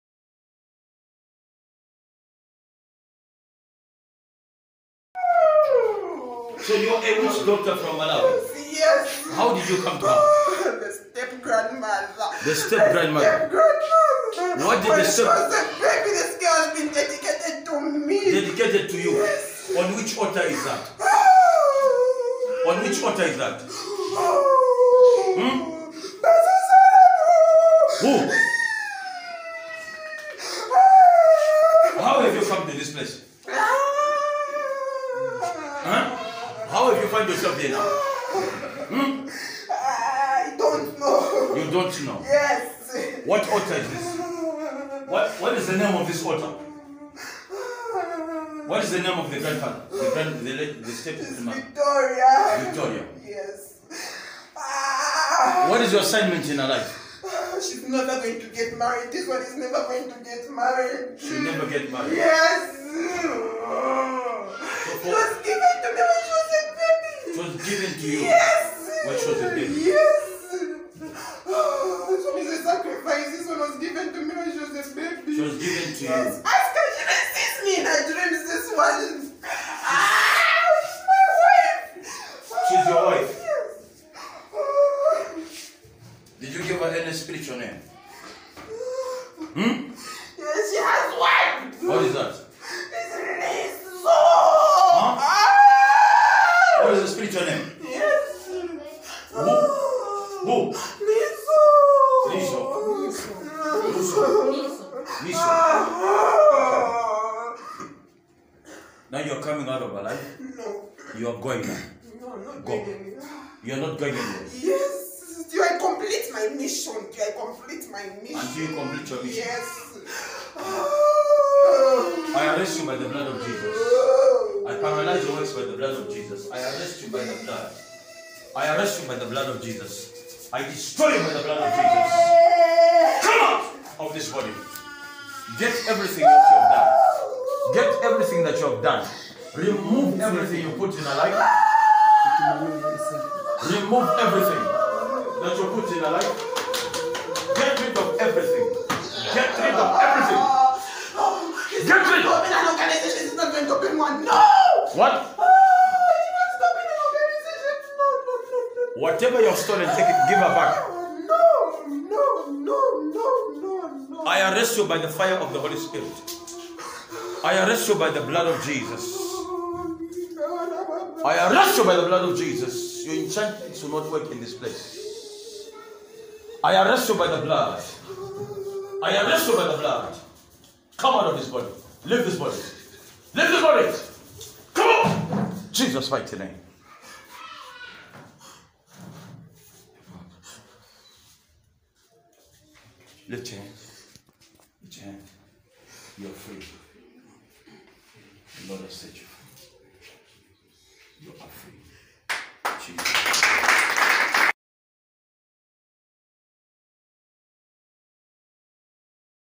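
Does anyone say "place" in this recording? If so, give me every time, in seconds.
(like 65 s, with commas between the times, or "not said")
32 s, 174 s.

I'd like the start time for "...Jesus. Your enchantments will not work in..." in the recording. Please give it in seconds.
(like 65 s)
172 s.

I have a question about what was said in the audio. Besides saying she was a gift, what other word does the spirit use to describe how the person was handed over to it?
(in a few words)
A sacrifice.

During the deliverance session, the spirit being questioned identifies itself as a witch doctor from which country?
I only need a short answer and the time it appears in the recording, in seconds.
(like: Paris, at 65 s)
Malawi, at 7 s.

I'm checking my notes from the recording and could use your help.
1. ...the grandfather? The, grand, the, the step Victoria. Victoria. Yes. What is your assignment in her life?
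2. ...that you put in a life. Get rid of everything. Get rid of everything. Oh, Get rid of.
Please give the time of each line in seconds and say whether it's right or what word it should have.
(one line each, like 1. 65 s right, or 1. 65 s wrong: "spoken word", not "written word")
1. 49 s right
2. 145 s right.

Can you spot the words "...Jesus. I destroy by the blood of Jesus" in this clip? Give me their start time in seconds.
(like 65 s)
129 s.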